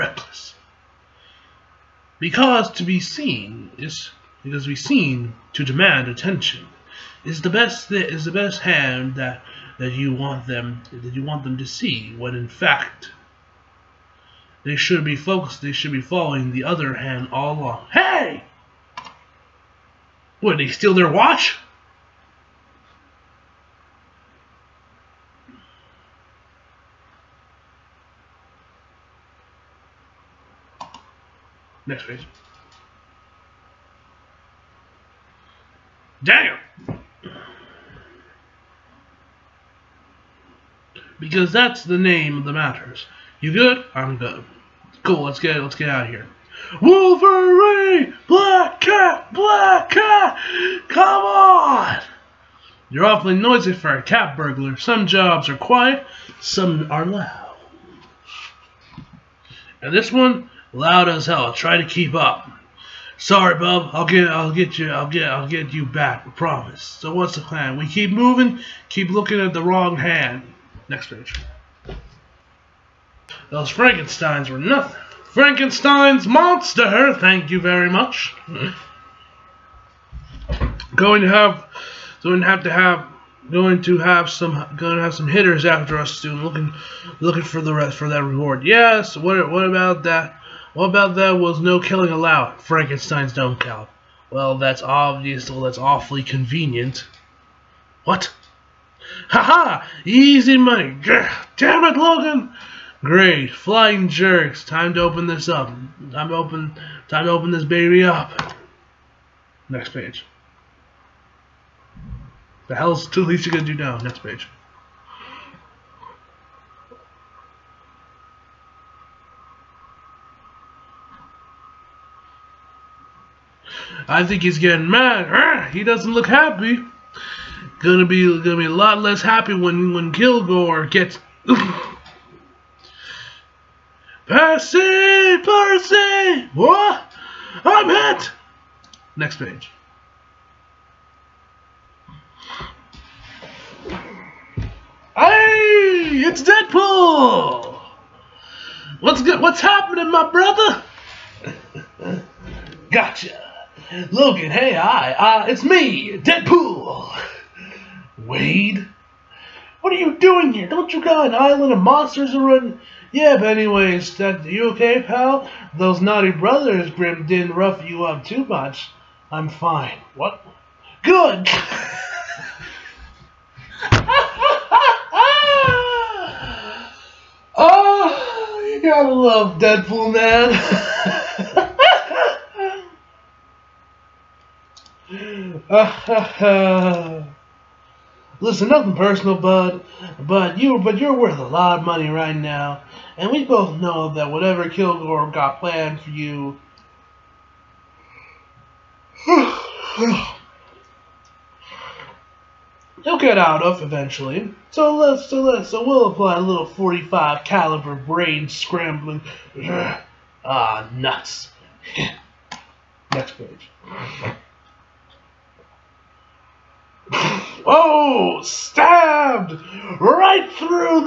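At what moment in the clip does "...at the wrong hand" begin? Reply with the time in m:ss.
1:09.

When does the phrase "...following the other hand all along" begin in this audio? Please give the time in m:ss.
0:16.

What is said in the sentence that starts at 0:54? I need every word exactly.
Some jobs are quiet, some are loud.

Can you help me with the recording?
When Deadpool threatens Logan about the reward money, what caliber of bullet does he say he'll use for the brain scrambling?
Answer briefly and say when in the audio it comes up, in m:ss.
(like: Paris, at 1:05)
45, at 3:26.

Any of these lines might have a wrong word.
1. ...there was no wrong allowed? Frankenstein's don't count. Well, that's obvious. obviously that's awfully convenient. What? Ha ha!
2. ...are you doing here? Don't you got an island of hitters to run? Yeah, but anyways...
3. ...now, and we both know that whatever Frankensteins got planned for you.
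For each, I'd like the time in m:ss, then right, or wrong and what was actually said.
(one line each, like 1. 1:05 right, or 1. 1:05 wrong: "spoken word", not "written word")
1. 1:31 wrong: "killing", not "wrong"
2. 2:39 wrong: "monsters", not "hitters"
3. 3:12 wrong: "Kilgore", not "Frankensteins".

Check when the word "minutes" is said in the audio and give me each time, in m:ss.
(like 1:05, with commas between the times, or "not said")
not said.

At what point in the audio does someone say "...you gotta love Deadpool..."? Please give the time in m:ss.
2:58.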